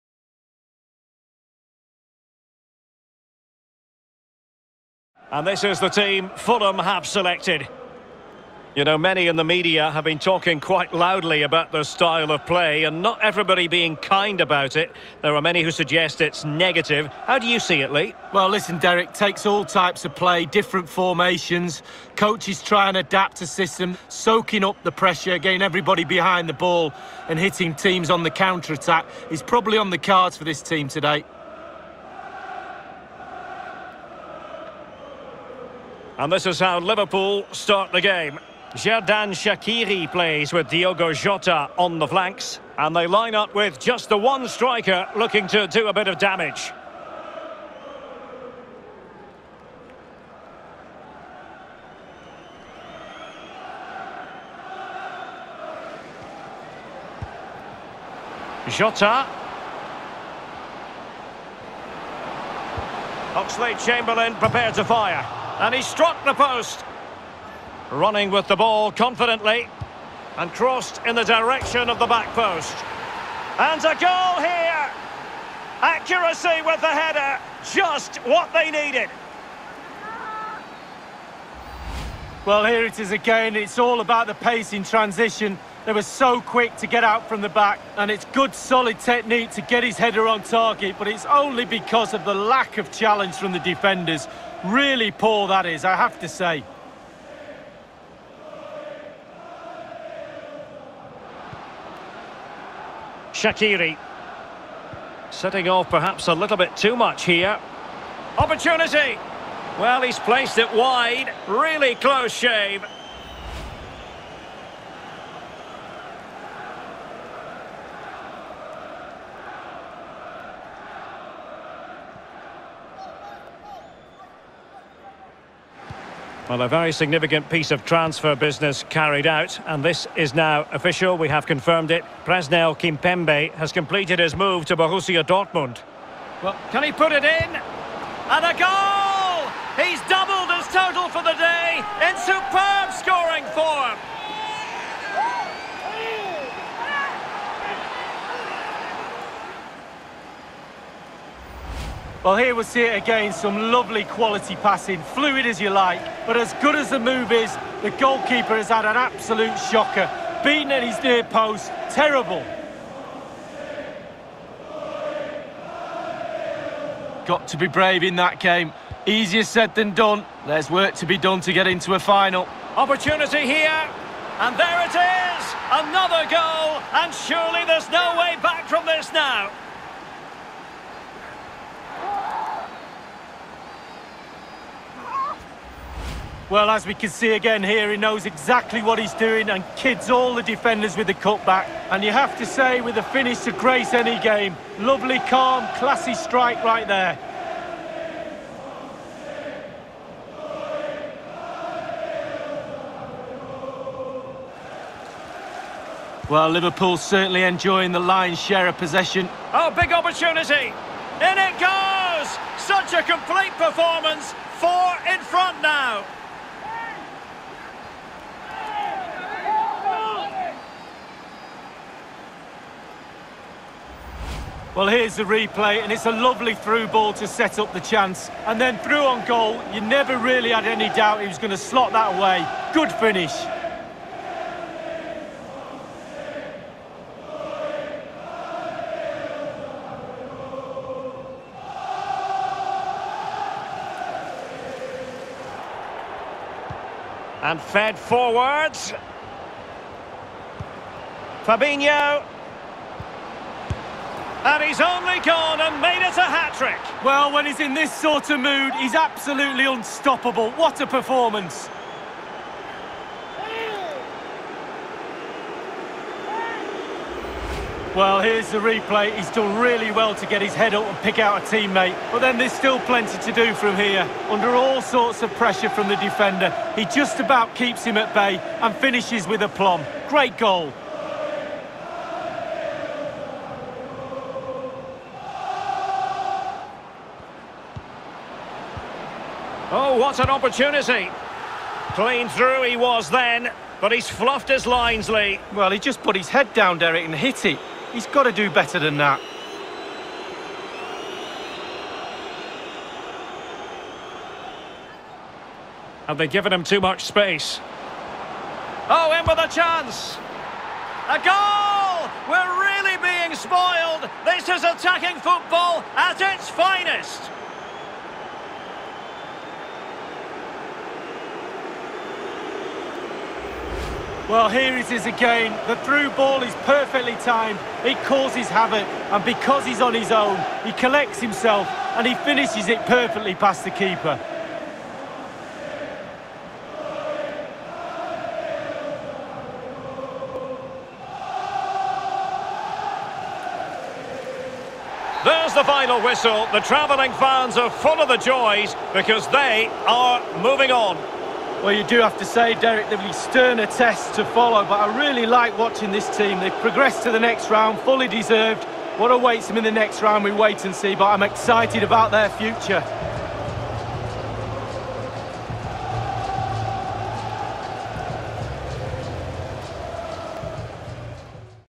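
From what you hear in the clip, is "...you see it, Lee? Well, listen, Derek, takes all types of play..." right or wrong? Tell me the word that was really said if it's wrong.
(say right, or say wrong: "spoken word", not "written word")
right.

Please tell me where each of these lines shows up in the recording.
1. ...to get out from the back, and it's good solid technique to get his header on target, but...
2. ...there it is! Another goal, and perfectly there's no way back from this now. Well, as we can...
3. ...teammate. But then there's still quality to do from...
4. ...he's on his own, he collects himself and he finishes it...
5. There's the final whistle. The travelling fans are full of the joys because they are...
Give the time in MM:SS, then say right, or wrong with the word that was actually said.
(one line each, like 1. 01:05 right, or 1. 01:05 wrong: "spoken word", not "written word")
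1. 01:26 right
2. 02:54 wrong: "surely", not "perfectly"
3. 04:31 wrong: "plenty", not "quality"
4. 05:29 right
5. 05:45 right.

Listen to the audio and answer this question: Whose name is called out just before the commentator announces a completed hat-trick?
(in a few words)
Fabinho.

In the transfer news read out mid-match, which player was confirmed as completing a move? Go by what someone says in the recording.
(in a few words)
Presnel Kimpembe.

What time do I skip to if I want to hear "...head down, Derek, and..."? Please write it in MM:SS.
04:56.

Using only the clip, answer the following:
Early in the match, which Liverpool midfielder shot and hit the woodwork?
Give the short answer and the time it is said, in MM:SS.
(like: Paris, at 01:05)
Oxlade Chamberlain, at 01:03.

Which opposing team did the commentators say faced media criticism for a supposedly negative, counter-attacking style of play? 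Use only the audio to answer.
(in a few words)
Fulham.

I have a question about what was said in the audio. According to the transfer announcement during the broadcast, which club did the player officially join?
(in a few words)
Borussia Dortmund.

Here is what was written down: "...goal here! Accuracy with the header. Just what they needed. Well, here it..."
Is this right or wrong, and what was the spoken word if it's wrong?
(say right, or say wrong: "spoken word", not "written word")
right.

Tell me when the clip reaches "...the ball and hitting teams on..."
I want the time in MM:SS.
00:26.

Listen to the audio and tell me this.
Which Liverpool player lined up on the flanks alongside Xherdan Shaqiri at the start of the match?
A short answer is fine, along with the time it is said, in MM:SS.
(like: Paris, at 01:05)
Diogo Jota, at 00:40.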